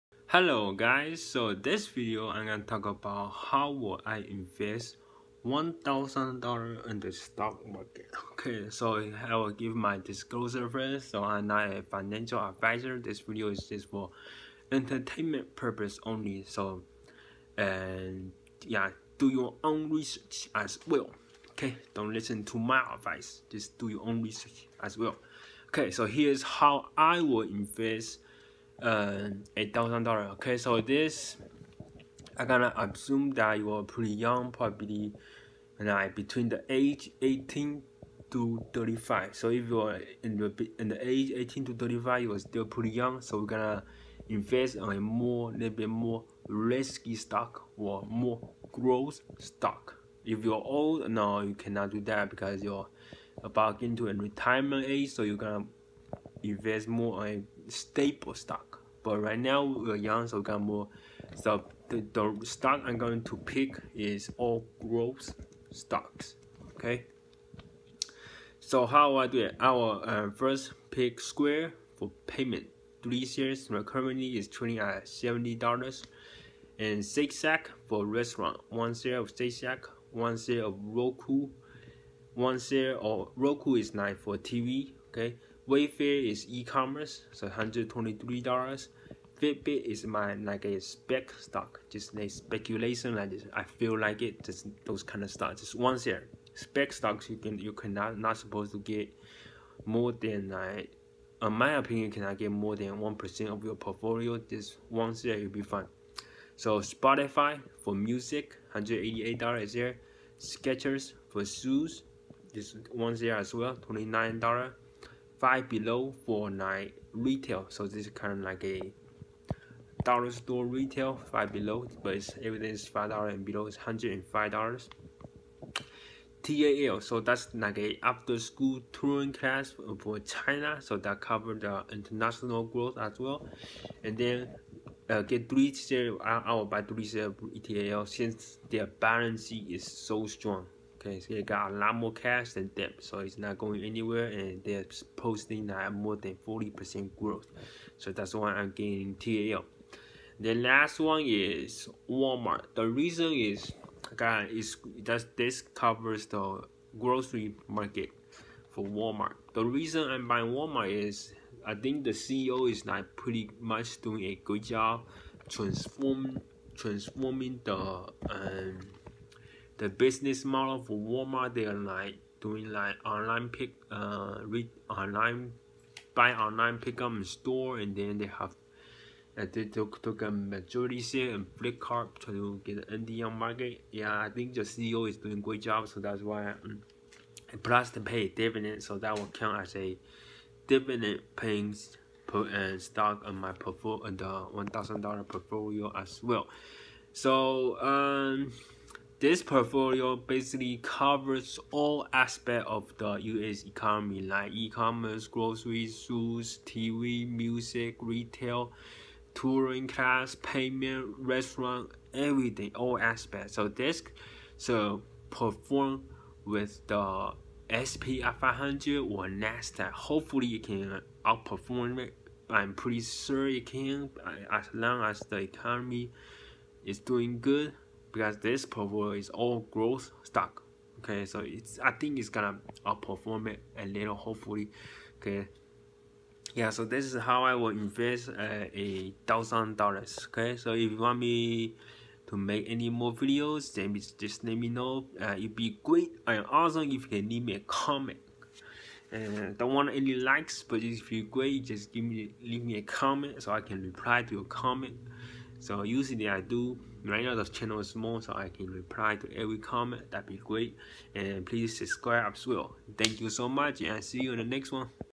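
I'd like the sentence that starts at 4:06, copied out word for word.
And also, if you can leave me a comment.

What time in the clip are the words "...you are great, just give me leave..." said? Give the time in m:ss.
4:11.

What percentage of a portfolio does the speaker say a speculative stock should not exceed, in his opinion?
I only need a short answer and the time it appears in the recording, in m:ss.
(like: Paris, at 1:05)
1%, at 1:42.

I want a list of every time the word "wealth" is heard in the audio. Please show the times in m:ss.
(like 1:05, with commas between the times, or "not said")
not said.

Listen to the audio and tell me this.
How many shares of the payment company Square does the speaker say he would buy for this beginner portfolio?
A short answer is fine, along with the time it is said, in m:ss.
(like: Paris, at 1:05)
3, at 1:13.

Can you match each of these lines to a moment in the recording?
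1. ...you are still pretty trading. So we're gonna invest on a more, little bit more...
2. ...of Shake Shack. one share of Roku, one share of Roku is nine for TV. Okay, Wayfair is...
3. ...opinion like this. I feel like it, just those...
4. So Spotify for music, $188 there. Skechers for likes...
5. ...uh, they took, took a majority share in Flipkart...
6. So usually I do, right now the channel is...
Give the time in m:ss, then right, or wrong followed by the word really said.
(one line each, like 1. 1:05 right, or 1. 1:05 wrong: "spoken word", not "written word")
1. 0:42 wrong: "young", not "trading"
2. 1:19 right
3. 1:32 wrong: "speculation", not "opinion"
4. 1:46 wrong: "shoes", not "likes"
5. 2:59 right
6. 4:15 right.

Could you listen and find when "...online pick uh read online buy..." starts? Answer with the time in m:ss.
2:53.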